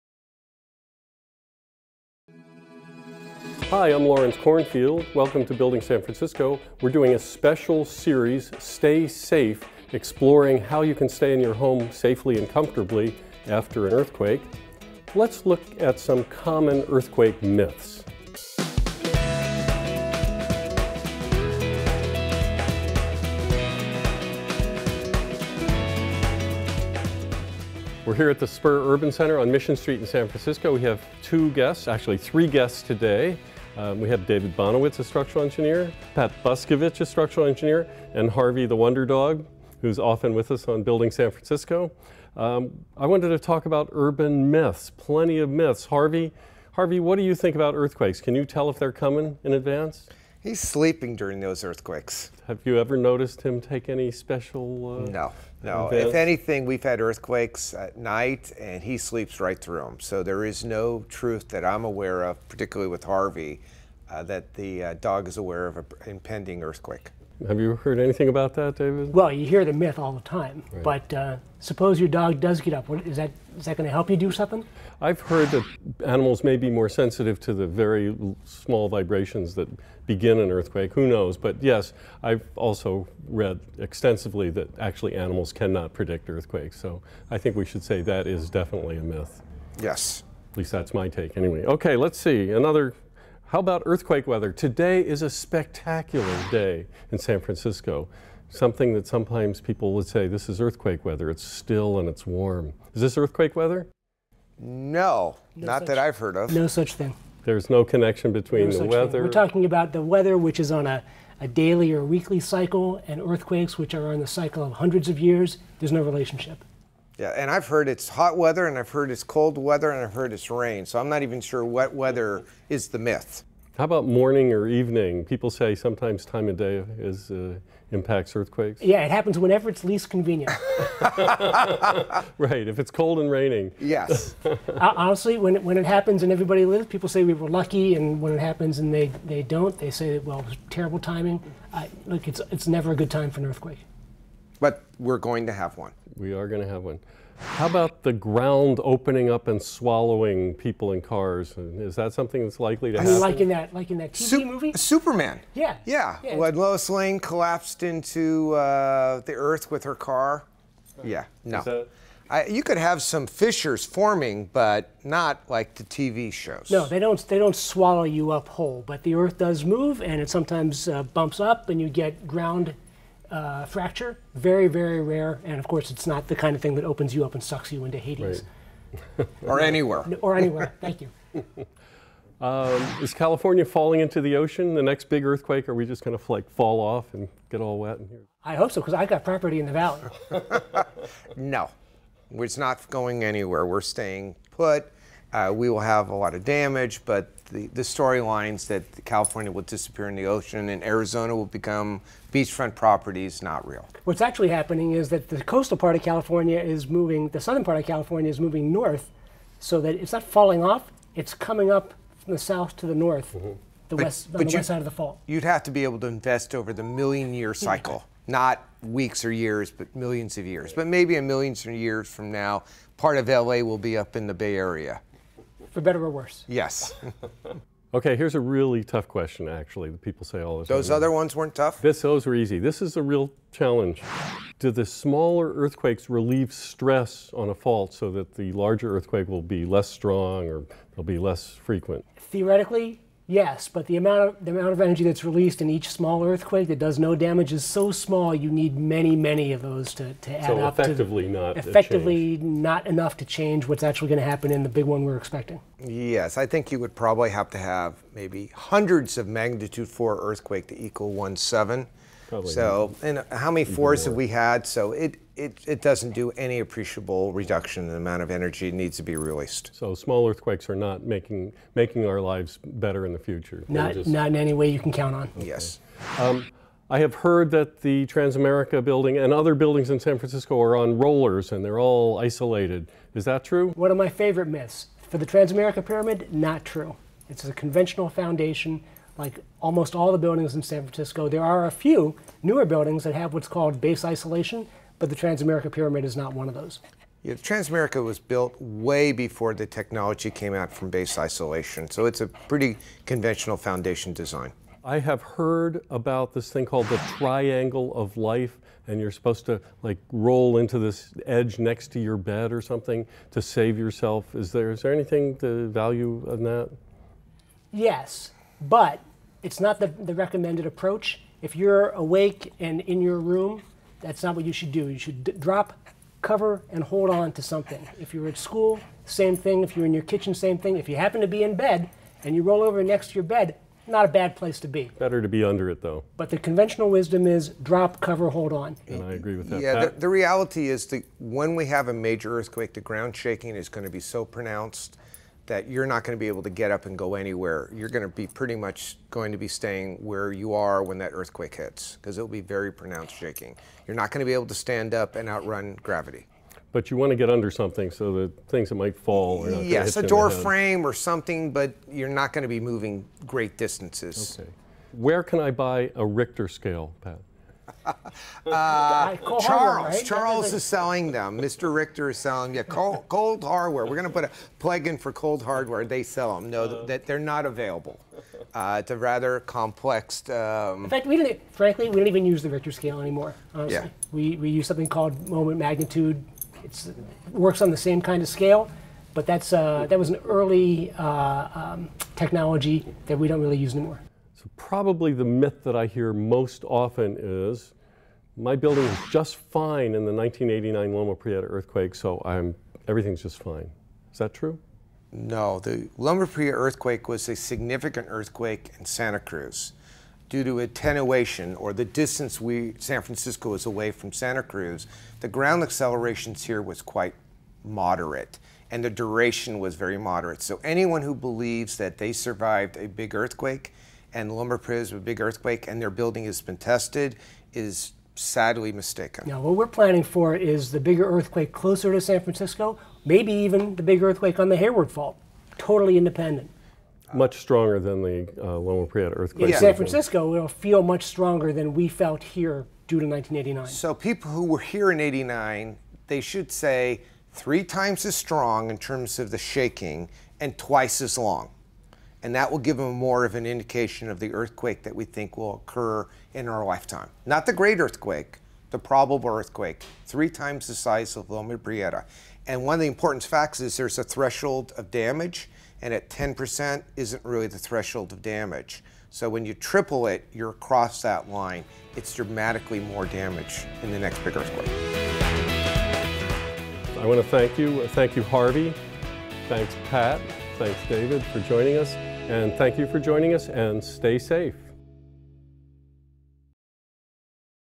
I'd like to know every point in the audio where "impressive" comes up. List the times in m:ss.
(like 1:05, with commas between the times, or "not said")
not said.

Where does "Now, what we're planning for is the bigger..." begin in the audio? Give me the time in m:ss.
7:09.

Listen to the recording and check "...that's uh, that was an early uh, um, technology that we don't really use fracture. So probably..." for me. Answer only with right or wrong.
wrong.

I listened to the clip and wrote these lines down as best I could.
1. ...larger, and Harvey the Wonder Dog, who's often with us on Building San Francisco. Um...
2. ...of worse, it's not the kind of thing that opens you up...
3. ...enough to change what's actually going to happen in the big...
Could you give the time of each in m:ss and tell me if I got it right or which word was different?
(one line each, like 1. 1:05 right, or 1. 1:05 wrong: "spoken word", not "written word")
1. 0:37 wrong: "engineer", not "larger"
2. 2:55 wrong: "course", not "worse"
3. 4:12 right.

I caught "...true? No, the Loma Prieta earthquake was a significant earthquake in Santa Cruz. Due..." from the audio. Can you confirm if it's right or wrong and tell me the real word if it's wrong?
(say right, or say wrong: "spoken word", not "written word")
right.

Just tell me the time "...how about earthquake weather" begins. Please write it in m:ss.
1:33.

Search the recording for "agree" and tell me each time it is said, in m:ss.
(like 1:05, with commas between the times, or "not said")
5:39.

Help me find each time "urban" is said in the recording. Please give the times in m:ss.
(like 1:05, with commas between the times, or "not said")
0:28, 0:43.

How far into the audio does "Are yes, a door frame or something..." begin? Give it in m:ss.
5:59.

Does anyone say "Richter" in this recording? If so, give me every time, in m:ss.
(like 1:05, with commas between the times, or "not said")
6:06, 6:11, 6:22.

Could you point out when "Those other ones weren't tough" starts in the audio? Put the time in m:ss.
3:50.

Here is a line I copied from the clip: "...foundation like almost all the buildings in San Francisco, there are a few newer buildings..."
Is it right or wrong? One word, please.
right.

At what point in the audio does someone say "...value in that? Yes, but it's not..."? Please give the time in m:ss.
5:15.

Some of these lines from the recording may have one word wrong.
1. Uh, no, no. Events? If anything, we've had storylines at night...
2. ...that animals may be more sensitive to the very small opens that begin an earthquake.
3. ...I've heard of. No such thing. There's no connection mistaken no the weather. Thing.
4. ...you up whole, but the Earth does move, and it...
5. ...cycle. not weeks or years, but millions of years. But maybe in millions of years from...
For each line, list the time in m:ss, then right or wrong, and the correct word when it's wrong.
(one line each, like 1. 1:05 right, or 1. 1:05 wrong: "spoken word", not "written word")
1. 0:55 wrong: "earthquakes", not "storylines"
2. 1:15 wrong: "vibrations", not "opens"
3. 1:45 wrong: "between", not "mistaken"
4. 2:48 right
5. 3:37 right.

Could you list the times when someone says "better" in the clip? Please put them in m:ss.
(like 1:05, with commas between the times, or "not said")
3:45, 4:32, 5:34.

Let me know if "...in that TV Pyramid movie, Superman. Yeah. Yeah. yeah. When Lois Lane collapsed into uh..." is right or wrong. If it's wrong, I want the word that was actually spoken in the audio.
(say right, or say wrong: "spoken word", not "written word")
wrong: "Sup", not "Pyramid".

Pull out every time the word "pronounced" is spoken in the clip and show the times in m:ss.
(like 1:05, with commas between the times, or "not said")
5:44, 5:52.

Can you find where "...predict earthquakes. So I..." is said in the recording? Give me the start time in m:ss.
1:25.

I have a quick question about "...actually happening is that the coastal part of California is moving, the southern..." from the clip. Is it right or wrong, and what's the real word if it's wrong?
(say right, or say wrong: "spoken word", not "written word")
right.